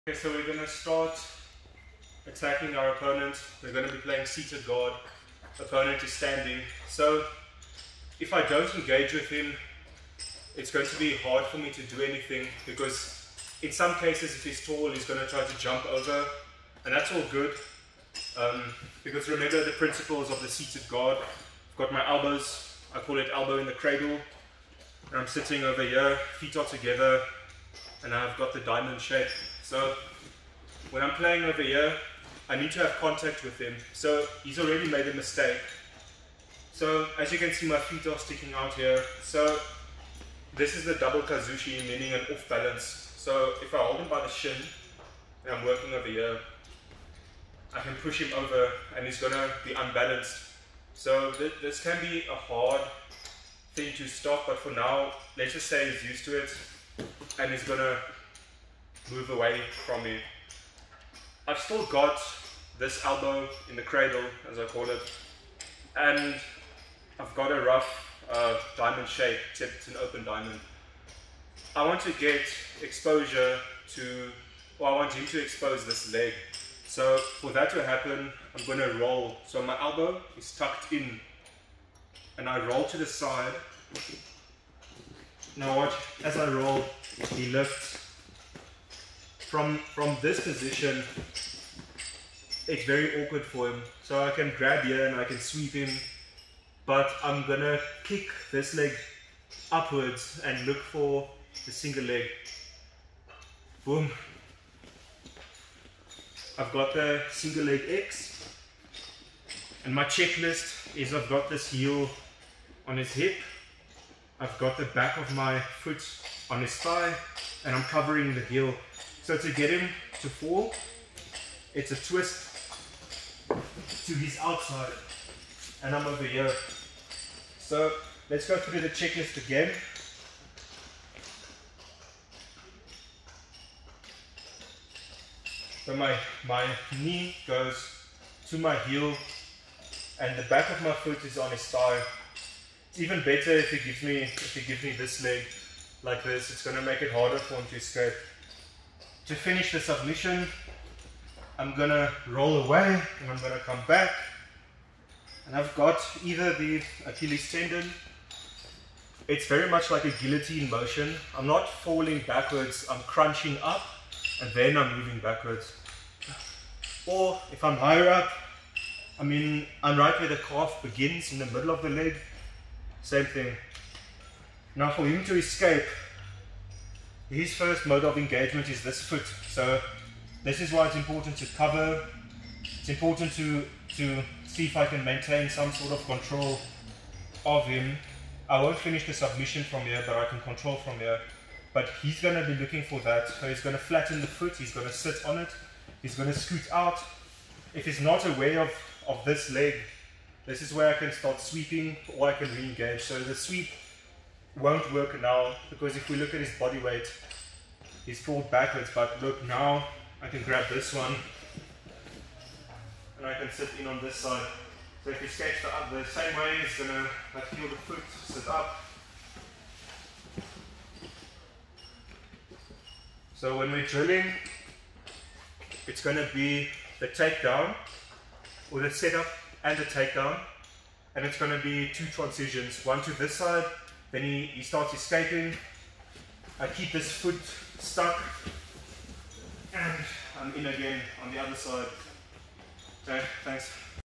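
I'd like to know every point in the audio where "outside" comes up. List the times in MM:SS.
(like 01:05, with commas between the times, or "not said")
02:04.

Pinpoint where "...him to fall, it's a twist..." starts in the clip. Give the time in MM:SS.
01:59.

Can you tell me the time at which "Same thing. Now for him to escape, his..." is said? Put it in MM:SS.
02:53.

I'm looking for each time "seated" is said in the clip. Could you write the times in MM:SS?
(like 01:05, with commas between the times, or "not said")
00:04, 00:20.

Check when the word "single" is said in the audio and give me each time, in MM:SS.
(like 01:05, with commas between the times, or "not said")
01:41, 01:47.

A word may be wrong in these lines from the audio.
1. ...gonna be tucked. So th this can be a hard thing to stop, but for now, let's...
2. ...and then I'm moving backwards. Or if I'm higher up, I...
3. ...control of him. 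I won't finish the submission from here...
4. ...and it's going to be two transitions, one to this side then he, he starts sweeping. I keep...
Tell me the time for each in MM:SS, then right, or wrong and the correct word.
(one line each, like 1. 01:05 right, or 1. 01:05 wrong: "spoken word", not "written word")
1. 00:49 wrong: "unbalanced", not "tucked"
2. 02:44 right
3. 03:06 right
4. 03:51 wrong: "escaping", not "sweeping".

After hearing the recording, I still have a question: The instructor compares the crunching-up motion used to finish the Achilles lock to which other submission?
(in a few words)
Guillotine.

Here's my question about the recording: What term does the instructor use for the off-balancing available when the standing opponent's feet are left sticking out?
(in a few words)
Double kazushi.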